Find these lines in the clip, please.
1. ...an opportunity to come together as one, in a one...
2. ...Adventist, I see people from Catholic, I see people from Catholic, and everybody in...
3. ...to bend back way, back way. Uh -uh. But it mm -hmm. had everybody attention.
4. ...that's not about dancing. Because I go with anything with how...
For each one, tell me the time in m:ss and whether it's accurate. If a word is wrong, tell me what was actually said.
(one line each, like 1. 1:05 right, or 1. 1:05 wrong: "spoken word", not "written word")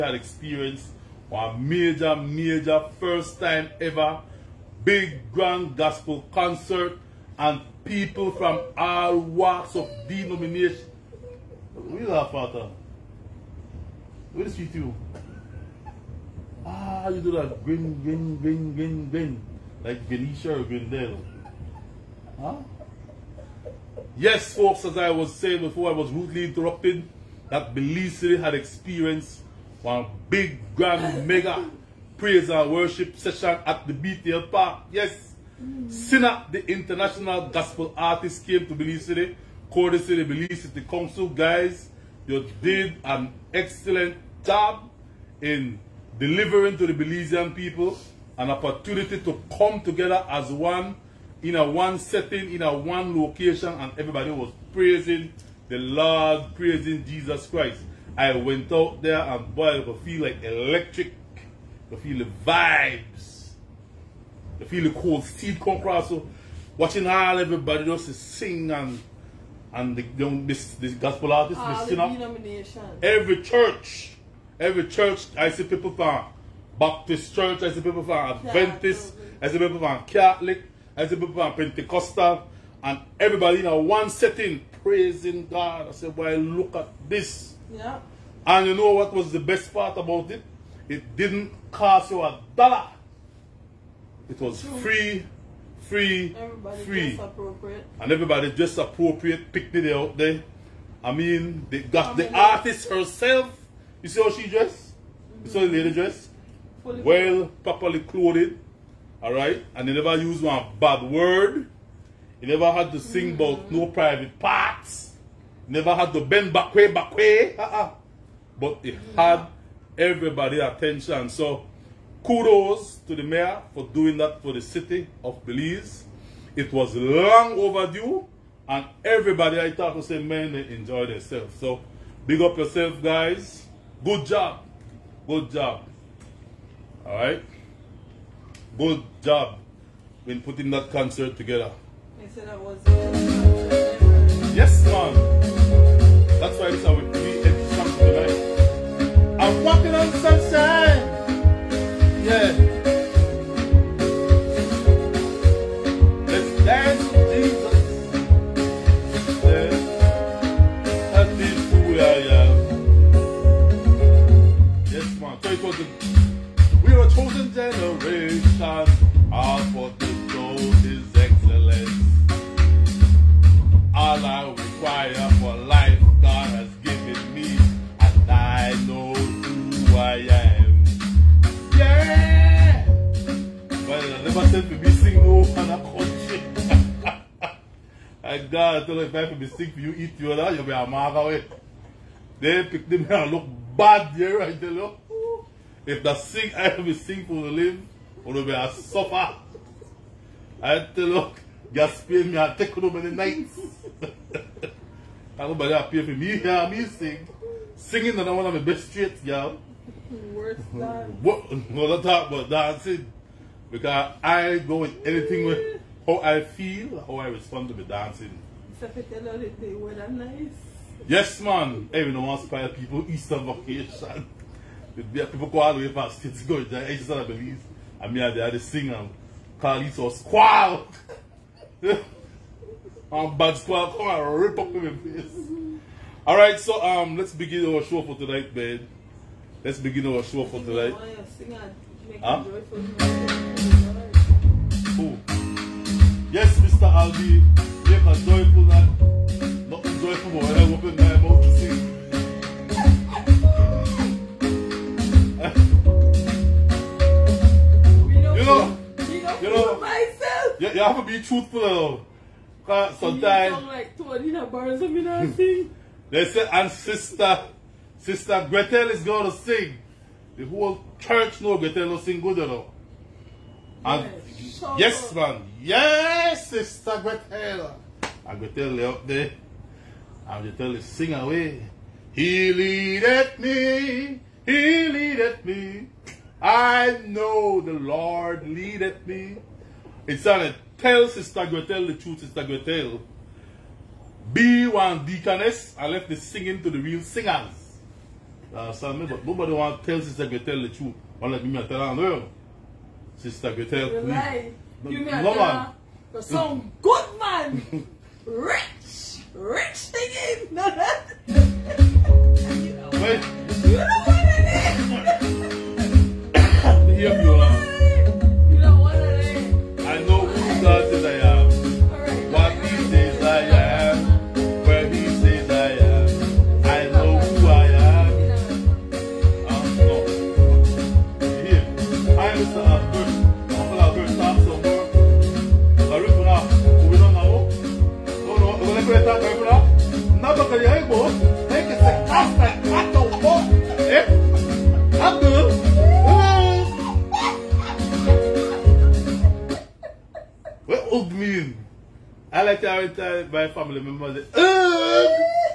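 1. 0:48 right
2. 1:18 wrong: "Pentecostal", not "Catholic"
3. 1:56 right
4. 3:31 right.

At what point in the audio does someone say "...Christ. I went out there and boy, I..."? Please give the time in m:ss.
0:57.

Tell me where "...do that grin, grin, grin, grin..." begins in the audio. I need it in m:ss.
0:17.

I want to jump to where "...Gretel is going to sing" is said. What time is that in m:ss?
4:28.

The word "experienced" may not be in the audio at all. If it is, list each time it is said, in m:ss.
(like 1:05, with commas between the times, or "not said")
0:00, 0:28.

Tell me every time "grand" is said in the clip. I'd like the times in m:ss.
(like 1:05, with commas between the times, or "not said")
0:05, 0:30.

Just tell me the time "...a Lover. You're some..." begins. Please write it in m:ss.
5:05.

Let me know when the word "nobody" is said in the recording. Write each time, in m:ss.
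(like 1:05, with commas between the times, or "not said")
3:25, 4:59.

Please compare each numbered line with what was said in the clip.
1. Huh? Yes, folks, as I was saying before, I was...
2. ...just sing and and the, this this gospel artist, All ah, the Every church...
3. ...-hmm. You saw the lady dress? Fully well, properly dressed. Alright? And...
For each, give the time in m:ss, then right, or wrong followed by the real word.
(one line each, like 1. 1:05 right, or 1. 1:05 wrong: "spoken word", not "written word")
1. 0:22 right
2. 1:07 right
3. 1:45 wrong: "clothed", not "dressed".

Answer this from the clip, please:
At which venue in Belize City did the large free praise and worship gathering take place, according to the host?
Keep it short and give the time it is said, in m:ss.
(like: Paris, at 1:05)
BTL Park, at 0:33.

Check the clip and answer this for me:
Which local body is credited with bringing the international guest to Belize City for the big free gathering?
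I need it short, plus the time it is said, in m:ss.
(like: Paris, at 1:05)
Belize City Council, at 0:40.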